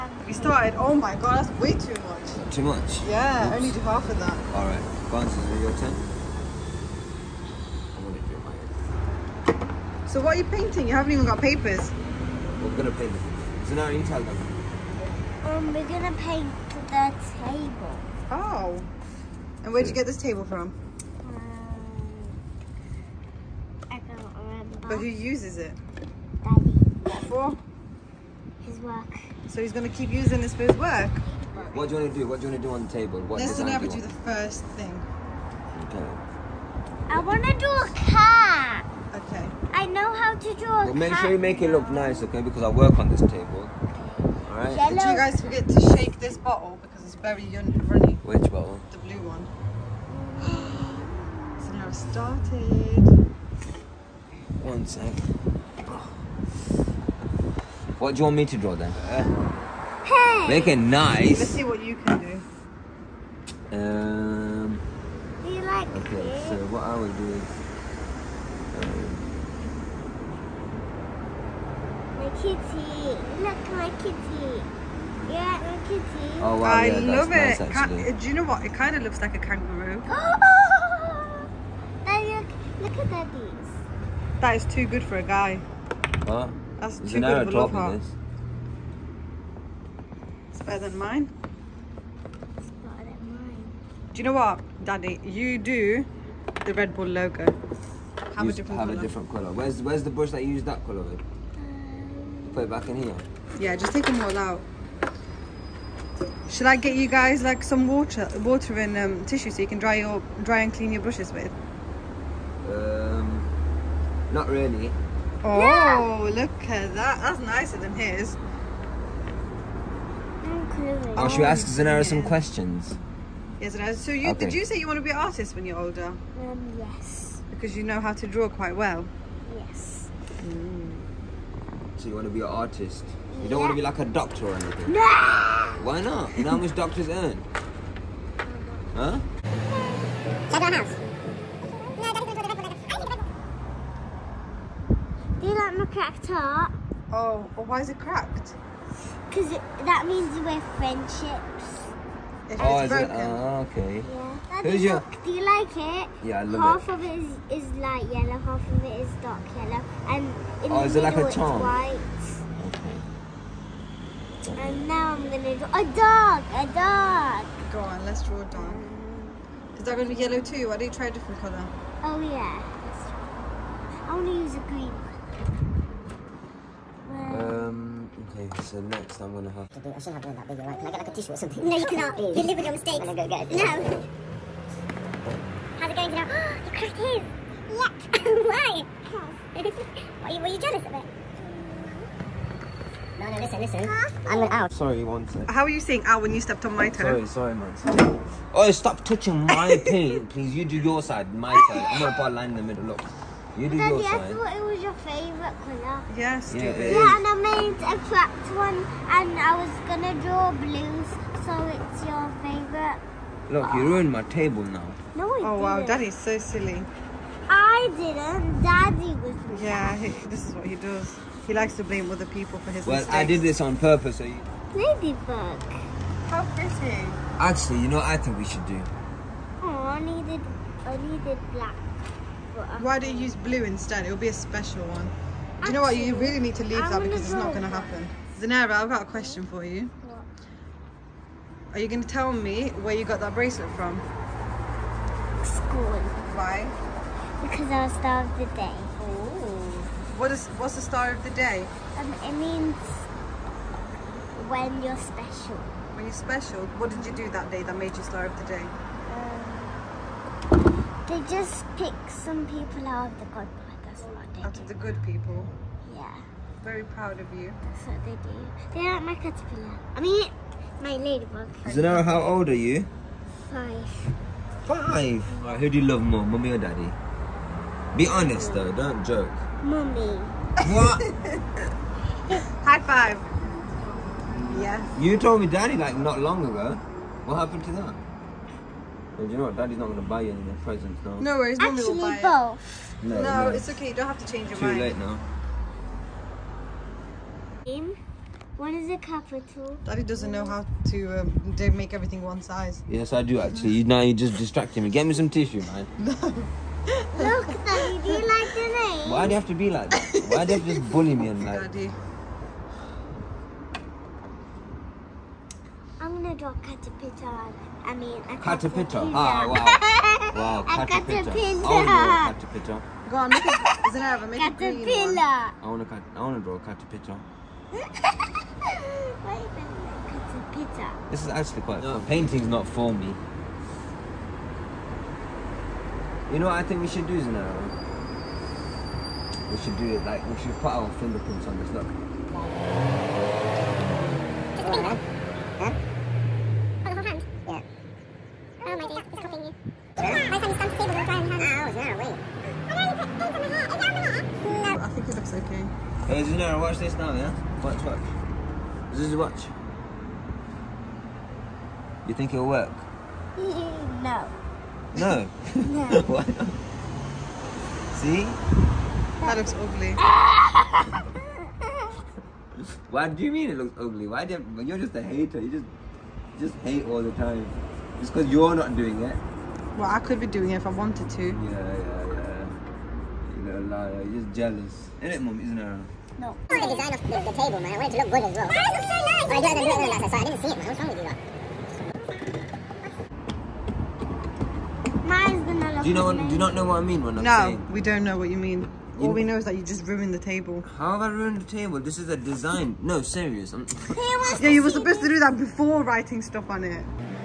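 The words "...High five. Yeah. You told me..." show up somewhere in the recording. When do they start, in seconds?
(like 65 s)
282 s.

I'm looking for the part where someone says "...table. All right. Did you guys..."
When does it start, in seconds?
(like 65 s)
43 s.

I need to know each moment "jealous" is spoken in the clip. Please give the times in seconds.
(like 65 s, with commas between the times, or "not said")
190 s, 384 s.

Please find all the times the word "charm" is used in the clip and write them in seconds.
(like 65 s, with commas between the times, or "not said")
161 s.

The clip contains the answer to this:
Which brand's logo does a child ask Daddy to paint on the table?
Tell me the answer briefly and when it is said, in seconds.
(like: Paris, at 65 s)
Red Bull, at 96 s.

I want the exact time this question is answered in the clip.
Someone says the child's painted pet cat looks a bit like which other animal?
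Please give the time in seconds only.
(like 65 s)
79 s.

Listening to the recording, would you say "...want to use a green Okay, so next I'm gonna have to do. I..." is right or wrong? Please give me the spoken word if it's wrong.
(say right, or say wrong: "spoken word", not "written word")
right.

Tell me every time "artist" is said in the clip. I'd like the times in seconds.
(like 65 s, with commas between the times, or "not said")
125 s, 132 s.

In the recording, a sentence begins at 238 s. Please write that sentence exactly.
Zunaira, I've got a question for you.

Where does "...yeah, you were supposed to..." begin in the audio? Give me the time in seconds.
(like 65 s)
404 s.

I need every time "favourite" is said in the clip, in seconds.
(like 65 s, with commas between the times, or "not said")
204 s, 212 s.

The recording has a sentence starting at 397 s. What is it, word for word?
No, we don't know what you mean.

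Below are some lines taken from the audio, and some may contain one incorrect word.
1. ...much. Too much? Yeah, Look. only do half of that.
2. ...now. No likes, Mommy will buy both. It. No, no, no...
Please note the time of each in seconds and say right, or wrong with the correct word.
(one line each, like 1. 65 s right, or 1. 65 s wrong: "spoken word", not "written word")
1. 2 s wrong: "Oops", not "Look"
2. 291 s wrong: "worries", not "likes".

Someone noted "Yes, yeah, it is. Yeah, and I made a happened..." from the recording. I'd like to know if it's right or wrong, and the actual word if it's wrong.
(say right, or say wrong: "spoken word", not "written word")
wrong: "cracked", not "happened".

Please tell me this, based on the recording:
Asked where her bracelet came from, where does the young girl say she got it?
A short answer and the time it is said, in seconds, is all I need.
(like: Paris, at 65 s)
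School, at 245 s.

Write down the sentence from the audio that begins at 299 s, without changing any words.
Daddy doesn't know how to um, make everything one size.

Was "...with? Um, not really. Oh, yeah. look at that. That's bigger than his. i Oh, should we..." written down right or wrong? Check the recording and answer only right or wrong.
wrong.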